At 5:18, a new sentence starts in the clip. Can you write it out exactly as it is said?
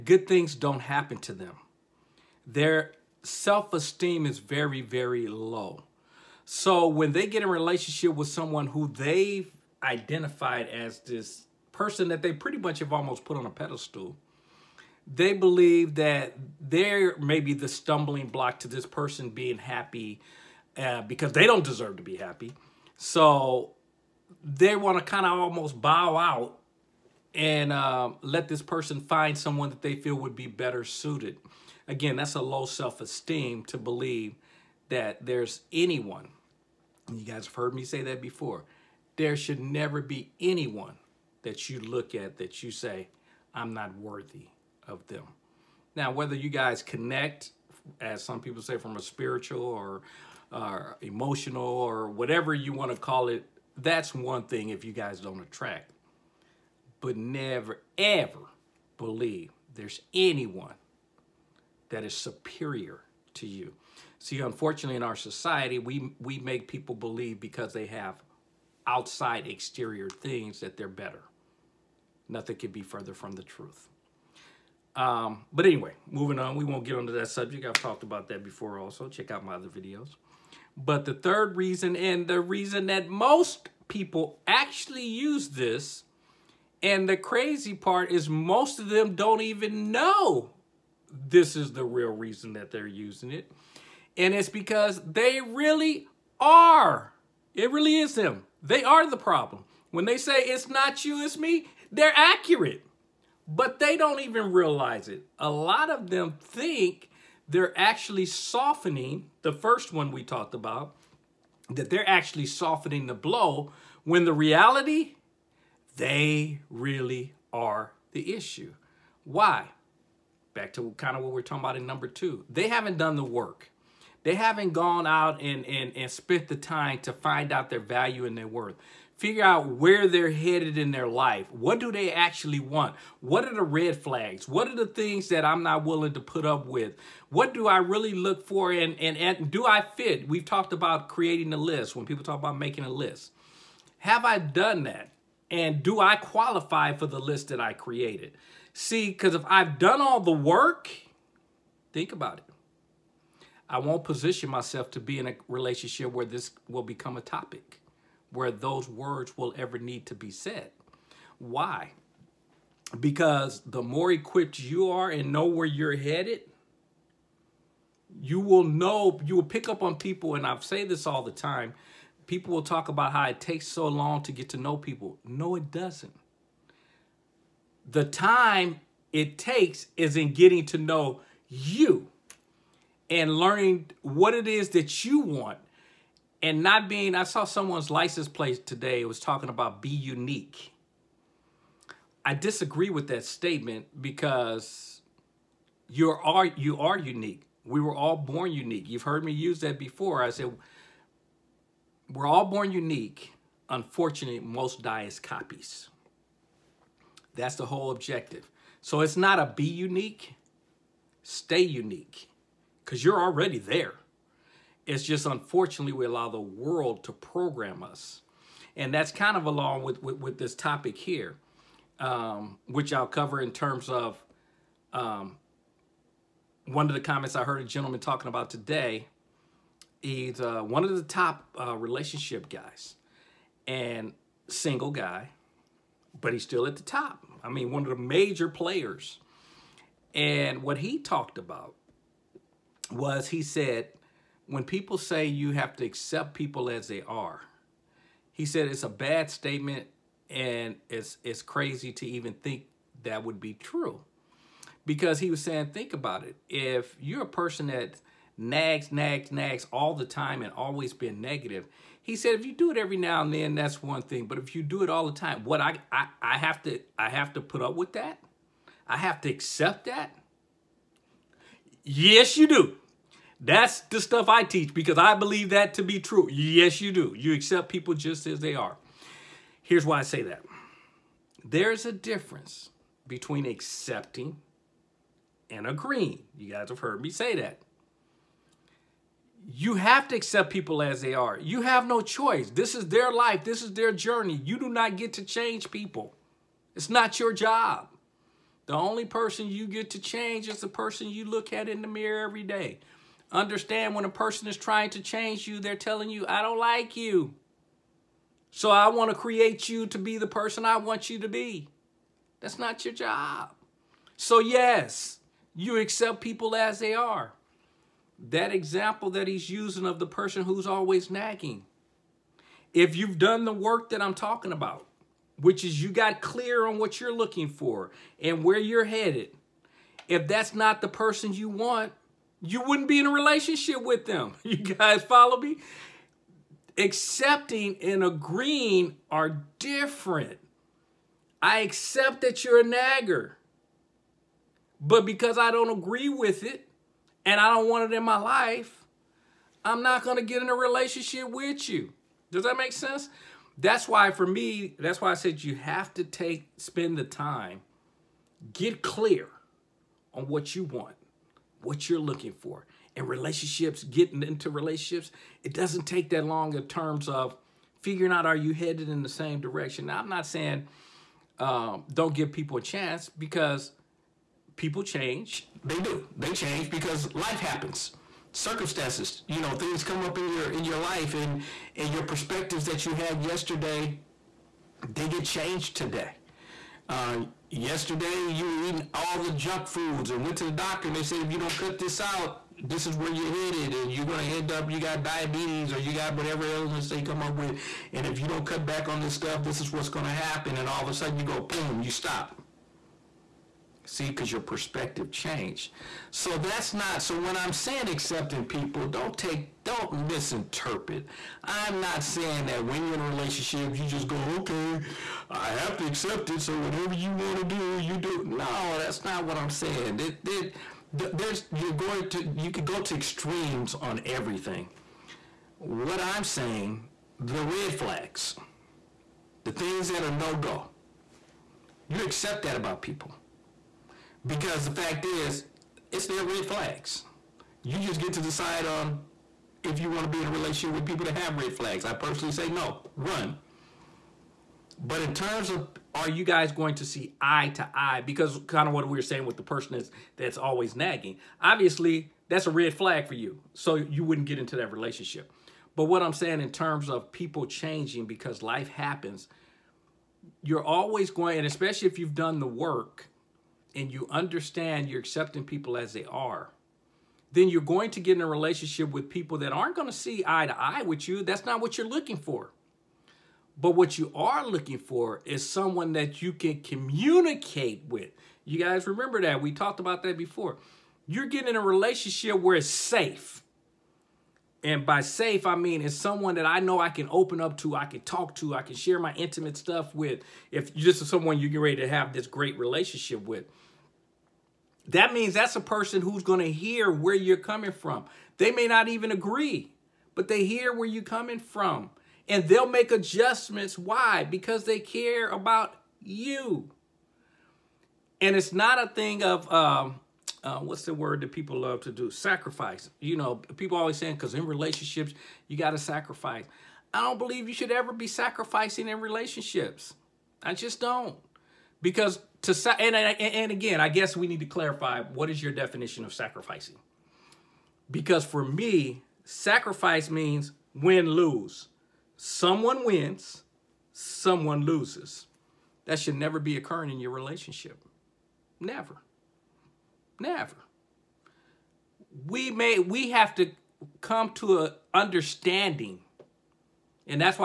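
That example that he's using of the person who's always nagging.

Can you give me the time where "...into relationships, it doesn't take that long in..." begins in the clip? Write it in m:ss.
6:04.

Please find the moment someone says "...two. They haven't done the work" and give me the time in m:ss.
2:02.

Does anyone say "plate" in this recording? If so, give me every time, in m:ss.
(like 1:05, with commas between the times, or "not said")
3:08.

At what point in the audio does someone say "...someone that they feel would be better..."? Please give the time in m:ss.
0:29.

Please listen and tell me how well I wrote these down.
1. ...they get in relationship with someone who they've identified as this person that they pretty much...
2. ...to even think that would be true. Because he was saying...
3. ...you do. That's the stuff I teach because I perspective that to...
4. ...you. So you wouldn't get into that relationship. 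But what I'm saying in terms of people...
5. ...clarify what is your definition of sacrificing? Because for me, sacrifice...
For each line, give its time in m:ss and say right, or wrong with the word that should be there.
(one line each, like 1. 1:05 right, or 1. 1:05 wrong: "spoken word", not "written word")
1. 0:07 right
2. 4:11 right
3. 4:32 wrong: "believe", not "perspective"
4. 7:33 right
5. 8:44 right.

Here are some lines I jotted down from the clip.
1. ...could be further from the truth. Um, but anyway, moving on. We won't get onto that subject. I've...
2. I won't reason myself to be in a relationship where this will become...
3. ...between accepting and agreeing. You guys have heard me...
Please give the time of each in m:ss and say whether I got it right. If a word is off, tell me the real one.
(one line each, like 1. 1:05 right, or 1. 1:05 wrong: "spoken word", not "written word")
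1. 1:12 right
2. 2:33 wrong: "position", not "reason"
3. 4:43 right.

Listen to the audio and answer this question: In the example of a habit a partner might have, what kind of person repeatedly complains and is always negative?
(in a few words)
A nagger.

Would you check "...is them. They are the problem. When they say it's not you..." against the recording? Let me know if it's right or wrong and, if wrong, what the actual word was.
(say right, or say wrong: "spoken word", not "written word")
right.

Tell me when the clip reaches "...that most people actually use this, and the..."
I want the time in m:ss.
1:22.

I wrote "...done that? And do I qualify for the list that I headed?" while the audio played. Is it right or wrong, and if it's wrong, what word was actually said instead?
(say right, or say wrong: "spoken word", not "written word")
wrong: "created", not "headed".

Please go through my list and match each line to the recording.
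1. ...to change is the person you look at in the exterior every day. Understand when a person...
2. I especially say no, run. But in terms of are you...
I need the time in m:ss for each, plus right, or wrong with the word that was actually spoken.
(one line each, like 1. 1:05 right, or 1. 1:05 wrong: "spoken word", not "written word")
1. 4:59 wrong: "mirror", not "exterior"
2. 7:21 wrong: "personally", not "especially".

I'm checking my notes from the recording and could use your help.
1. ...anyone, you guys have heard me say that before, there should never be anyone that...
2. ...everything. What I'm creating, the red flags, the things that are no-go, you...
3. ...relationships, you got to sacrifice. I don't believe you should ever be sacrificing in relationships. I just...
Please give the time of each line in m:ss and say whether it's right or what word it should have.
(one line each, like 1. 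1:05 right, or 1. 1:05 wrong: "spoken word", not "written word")
1. 0:35 right
2. 7:04 wrong: "saying", not "creating"
3. 8:34 right.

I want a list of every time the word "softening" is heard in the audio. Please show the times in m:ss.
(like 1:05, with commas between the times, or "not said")
1:48, 1:52.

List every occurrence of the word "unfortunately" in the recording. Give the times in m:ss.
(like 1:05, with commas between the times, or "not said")
1:04, 3:23, 3:35.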